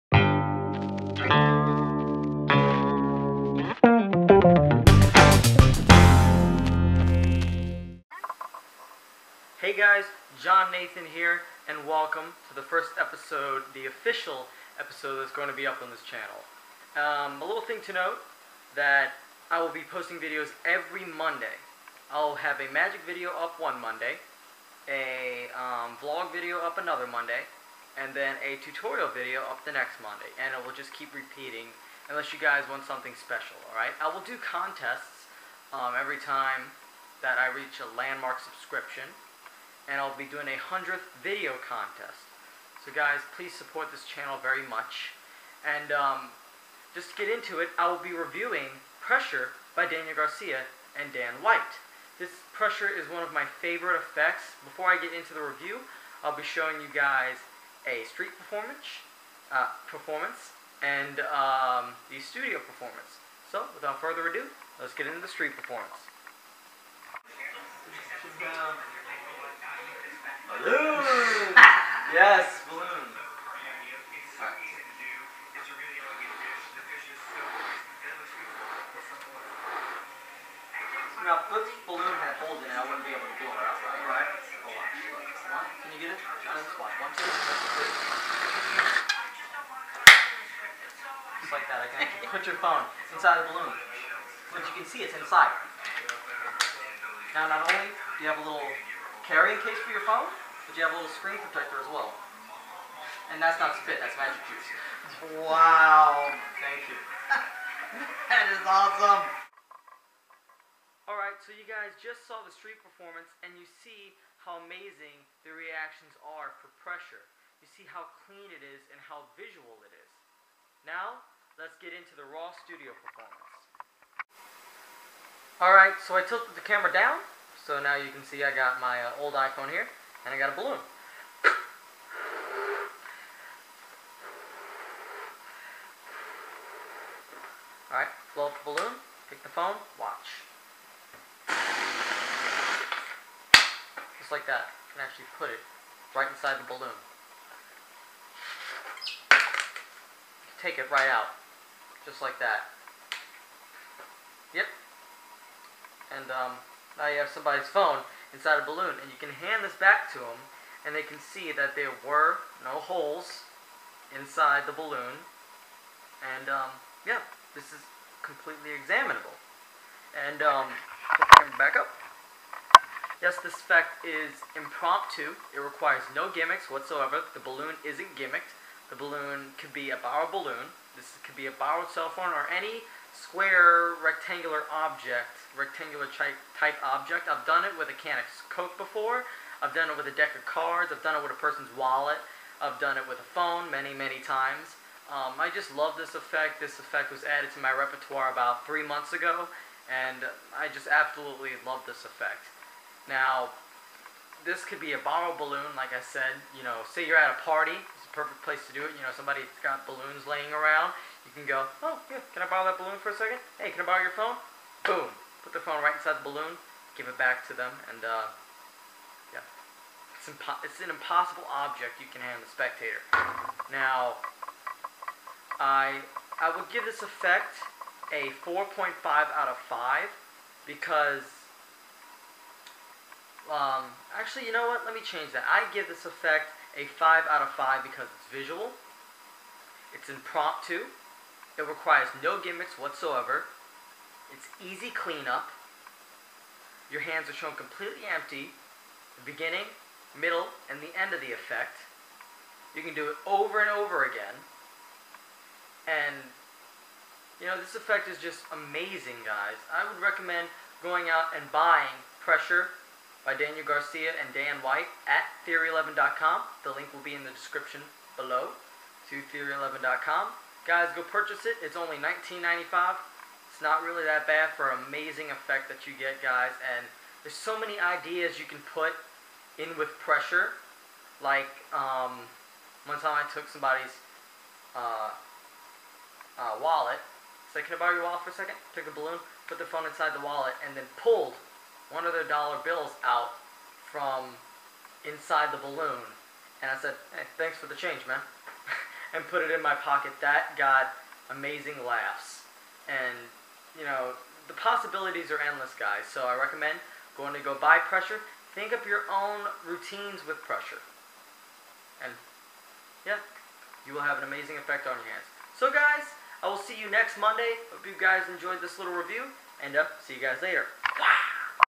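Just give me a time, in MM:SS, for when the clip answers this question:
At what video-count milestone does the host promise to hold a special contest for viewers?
00:40.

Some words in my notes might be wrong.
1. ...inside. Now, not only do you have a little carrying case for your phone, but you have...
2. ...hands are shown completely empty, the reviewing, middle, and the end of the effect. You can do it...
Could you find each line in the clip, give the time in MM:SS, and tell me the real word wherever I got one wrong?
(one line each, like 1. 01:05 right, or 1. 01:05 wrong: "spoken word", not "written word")
1. 01:35 right
2. 04:07 wrong: "beginning", not "reviewing".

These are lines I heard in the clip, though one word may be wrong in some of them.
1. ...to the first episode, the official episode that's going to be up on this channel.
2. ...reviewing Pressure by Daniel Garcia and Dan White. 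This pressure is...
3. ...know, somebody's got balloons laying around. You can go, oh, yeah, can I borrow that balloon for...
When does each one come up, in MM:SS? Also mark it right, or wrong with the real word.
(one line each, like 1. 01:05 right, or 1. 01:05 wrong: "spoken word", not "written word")
1. 00:12 right
2. 00:48 right
3. 03:29 right.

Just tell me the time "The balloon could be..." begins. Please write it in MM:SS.
02:58.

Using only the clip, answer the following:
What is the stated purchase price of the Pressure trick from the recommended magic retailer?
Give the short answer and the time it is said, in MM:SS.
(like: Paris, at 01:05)
$19.95, at 04:31.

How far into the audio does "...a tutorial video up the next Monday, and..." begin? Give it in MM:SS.
00:28.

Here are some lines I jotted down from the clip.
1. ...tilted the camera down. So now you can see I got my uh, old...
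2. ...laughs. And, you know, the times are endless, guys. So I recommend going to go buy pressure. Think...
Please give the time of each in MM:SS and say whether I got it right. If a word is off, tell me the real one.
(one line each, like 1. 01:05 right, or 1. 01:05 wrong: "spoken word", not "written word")
1. 02:06 right
2. 05:01 wrong: "possibilities", not "times".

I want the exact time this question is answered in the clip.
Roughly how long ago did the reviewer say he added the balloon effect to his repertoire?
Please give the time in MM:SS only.
03:18.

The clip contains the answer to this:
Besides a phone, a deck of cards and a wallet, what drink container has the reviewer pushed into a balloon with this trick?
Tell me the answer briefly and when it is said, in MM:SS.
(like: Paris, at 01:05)
A can of Coke, at 03:07.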